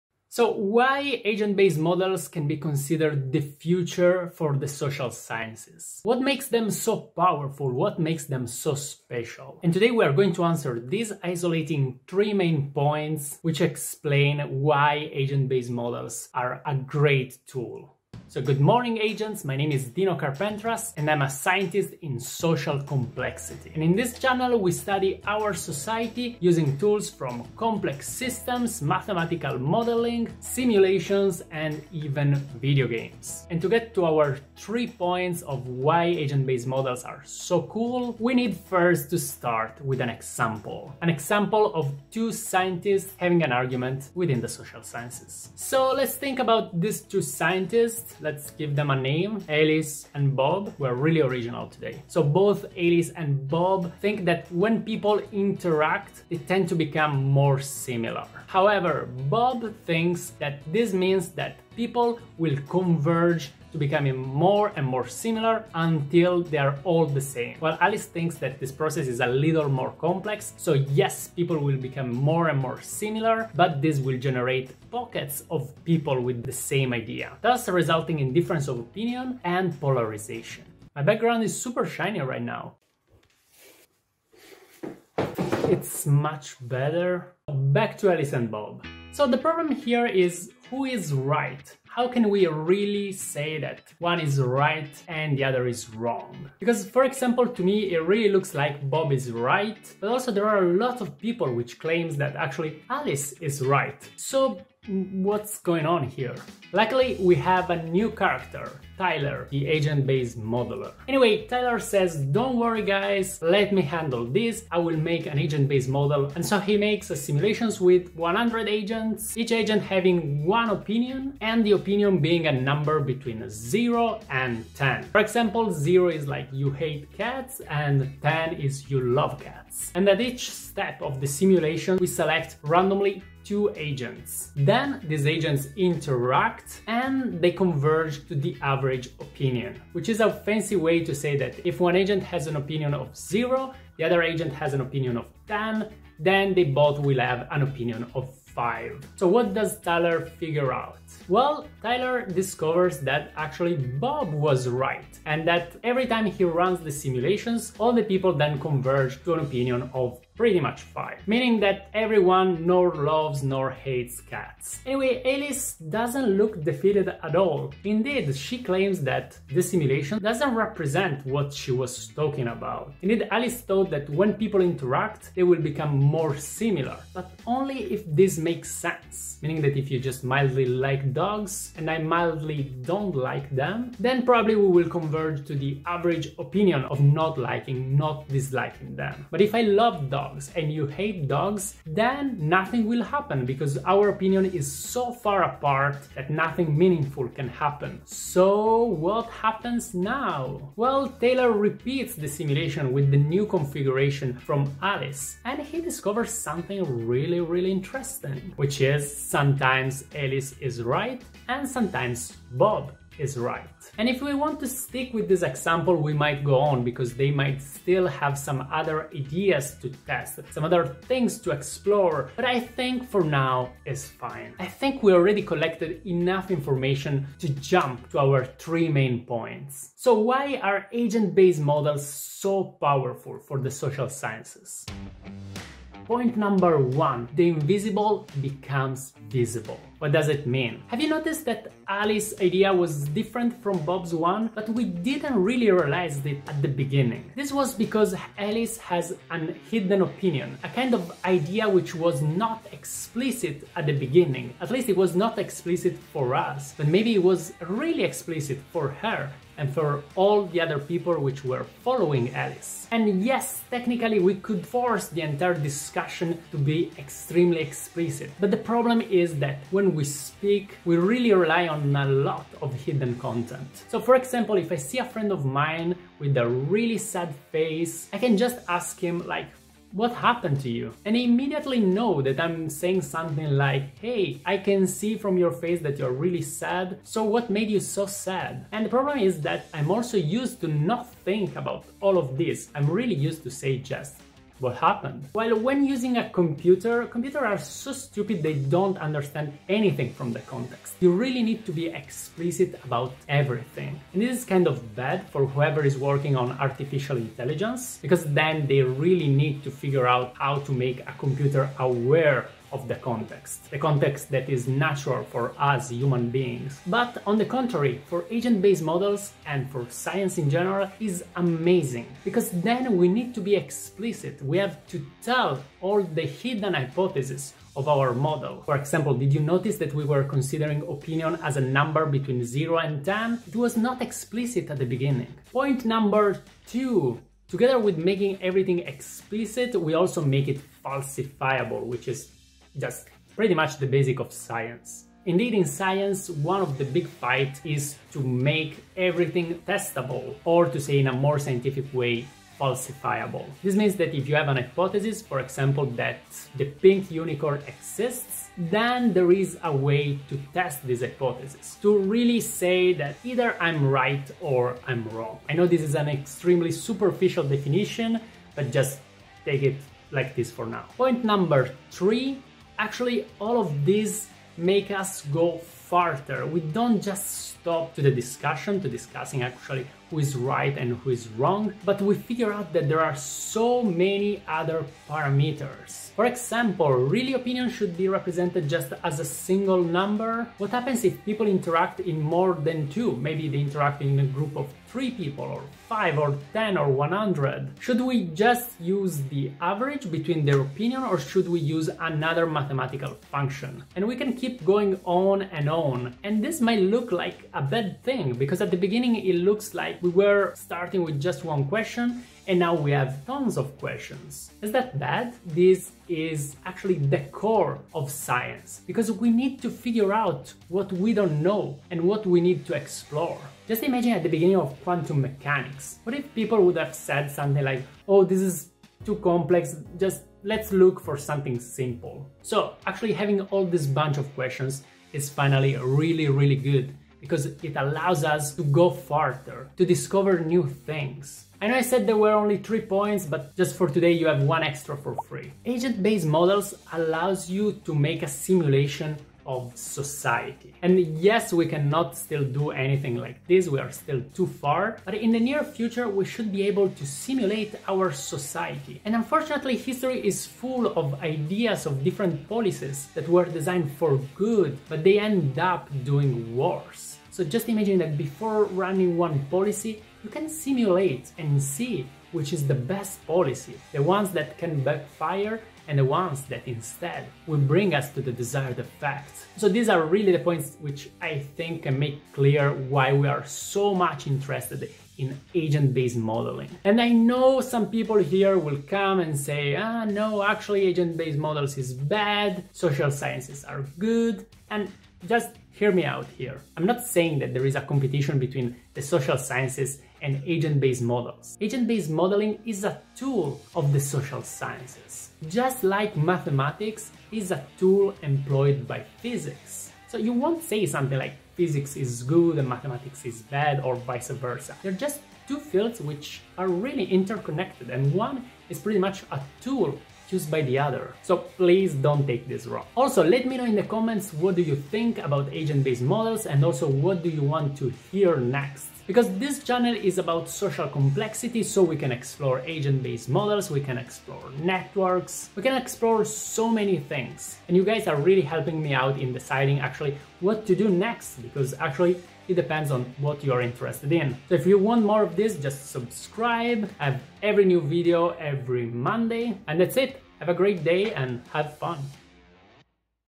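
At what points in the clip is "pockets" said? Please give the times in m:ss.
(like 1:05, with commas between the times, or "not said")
1:14.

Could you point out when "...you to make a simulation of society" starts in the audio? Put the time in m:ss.
7:27.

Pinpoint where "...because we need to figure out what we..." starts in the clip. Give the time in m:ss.
6:58.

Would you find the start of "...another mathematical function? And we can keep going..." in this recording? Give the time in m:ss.
6:42.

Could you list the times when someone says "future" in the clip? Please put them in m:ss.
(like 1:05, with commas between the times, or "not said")
0:03, 7:35.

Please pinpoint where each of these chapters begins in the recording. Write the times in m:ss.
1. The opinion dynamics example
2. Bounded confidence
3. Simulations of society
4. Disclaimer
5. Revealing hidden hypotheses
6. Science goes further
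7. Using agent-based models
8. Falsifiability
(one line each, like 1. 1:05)
1. 0:34
2. 2:45
3. 7:20
4. 8:06
5. 3:49
6. 6:10
7. 1:46
8. 5:34.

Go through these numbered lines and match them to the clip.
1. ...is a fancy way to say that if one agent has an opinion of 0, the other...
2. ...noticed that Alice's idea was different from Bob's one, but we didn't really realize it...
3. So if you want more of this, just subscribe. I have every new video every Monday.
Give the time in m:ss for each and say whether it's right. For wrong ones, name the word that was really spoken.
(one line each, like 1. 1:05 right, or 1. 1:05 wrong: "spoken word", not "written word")
1. 2:20 right
2. 4:01 right
3. 9:04 right.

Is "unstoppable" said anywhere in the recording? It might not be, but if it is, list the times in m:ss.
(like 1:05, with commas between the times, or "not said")
not said.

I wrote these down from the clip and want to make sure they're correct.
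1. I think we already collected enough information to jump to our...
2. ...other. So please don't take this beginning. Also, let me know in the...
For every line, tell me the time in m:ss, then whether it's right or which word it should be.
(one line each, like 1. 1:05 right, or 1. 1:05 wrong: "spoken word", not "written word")
1. 3:44 right
2. 8:40 wrong: "wrong", not "beginning".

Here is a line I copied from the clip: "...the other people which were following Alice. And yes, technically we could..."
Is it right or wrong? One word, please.
right.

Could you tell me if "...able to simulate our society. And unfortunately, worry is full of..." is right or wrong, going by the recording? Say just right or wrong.
wrong.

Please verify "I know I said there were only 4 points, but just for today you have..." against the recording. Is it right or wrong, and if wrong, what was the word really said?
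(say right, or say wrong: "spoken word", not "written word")
wrong: "3", not "4".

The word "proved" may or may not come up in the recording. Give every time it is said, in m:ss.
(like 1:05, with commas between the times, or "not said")
not said.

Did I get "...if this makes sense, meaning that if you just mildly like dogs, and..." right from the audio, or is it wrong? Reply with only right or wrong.
right.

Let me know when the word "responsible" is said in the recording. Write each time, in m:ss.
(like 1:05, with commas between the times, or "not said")
not said.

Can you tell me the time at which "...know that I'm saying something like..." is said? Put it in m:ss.
4:41.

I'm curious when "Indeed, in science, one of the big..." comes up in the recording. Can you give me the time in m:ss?
5:45.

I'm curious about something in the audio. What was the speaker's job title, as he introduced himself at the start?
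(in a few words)
scientist in social complexity.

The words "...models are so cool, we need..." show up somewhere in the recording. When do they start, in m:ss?
0:36.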